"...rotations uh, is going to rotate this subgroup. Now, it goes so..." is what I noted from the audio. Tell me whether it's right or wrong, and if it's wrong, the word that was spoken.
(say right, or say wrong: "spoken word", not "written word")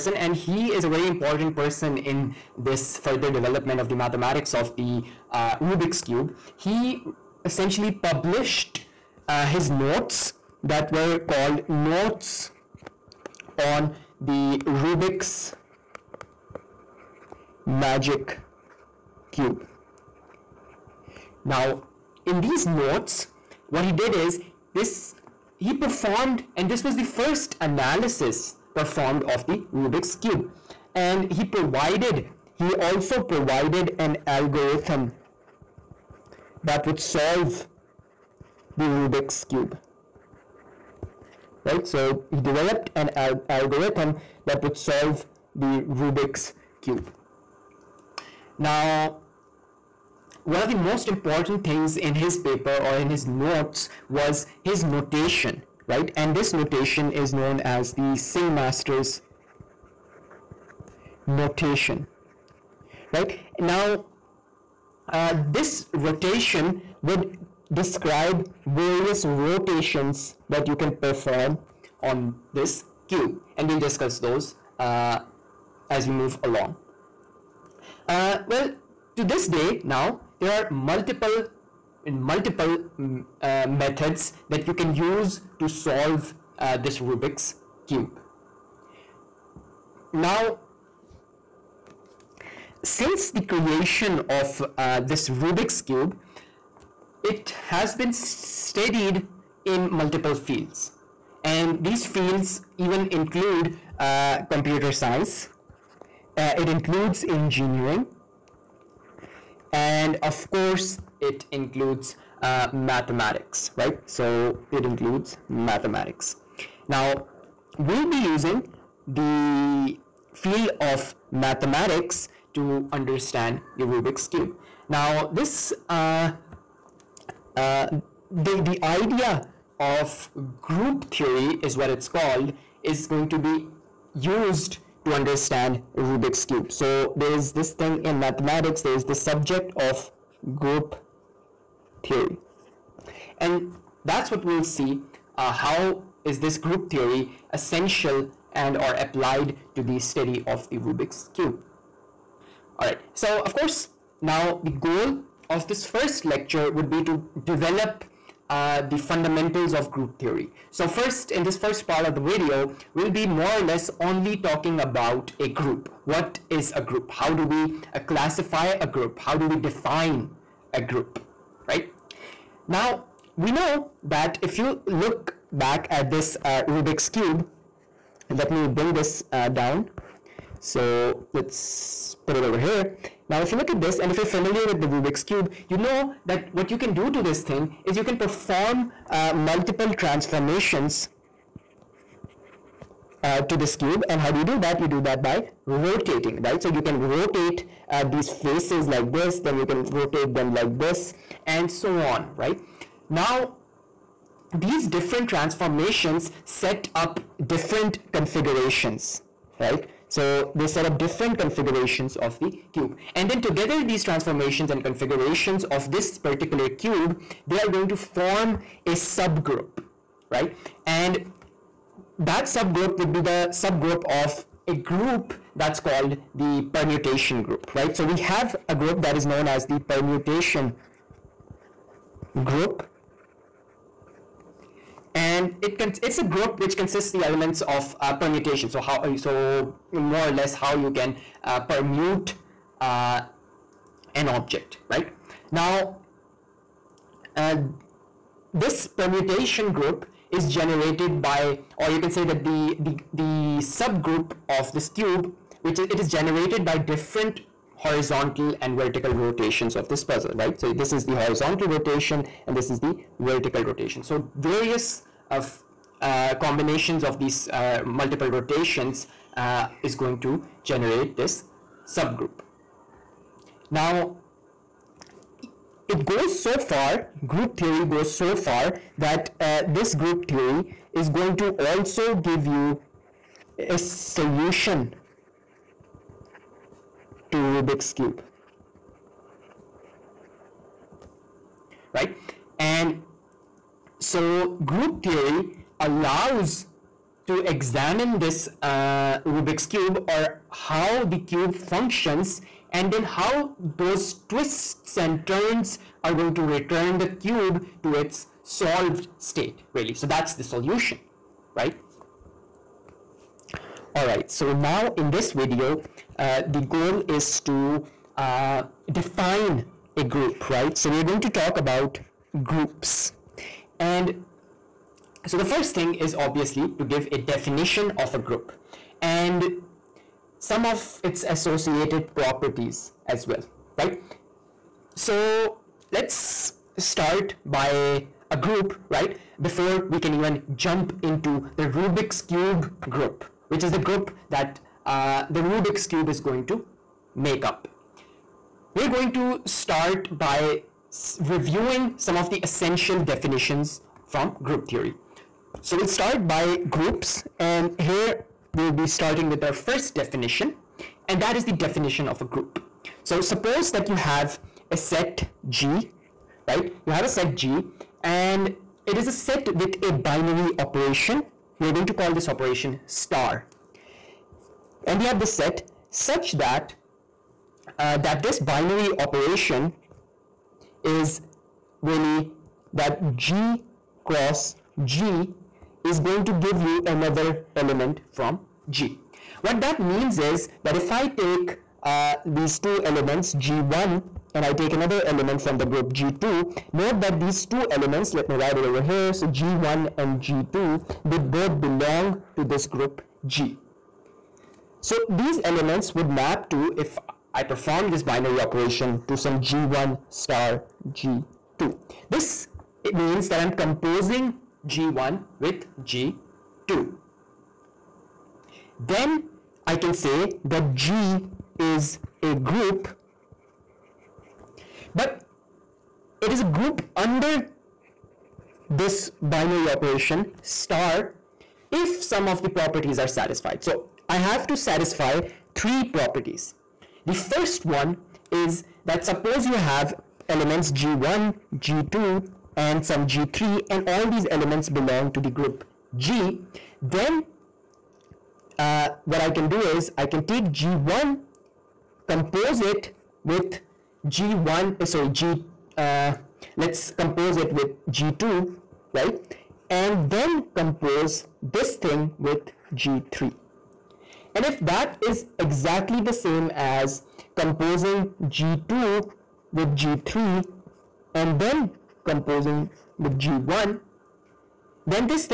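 wrong: "generate", not "rotate".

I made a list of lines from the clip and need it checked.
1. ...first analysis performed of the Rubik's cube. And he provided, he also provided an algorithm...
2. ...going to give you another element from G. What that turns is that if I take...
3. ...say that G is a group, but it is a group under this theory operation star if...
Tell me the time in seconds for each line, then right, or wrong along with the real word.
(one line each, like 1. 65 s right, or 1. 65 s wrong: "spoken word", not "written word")
1. 27 s right
2. 386 s wrong: "means", not "turns"
3. 419 s wrong: "binary", not "theory".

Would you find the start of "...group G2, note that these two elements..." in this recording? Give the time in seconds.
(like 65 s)
395 s.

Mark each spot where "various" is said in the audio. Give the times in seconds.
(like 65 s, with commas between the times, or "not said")
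68 s, 264 s.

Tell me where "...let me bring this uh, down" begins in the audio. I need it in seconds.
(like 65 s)
178 s.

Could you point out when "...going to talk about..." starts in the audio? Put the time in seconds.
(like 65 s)
321 s.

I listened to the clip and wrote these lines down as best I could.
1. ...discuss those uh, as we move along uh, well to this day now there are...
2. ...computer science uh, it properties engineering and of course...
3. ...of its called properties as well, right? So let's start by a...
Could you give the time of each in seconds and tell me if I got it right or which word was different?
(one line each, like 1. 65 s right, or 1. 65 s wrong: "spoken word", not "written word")
1. 73 s right
2. 104 s wrong: "includes", not "properties"
3. 330 s wrong: "associated", not "called".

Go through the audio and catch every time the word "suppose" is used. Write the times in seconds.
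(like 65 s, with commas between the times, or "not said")
363 s, 439 s.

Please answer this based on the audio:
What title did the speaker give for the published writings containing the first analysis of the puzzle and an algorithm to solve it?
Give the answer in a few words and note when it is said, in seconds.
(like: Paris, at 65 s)
Notes on the Rubik's Magic Cube, at 11 s.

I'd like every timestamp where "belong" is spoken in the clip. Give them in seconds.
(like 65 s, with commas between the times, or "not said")
401 s, 444 s.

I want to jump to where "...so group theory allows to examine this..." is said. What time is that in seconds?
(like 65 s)
294 s.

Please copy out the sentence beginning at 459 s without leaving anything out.
And then compose this thing with G3.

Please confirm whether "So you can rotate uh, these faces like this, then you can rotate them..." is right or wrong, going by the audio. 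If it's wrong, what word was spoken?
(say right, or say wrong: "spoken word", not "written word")
right.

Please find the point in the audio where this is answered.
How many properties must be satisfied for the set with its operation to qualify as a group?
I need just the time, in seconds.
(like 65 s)
435 s.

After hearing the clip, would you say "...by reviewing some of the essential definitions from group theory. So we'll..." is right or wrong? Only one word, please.
right.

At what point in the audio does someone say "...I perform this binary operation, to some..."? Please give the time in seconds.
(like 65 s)
407 s.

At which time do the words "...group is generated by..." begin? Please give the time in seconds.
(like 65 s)
249 s.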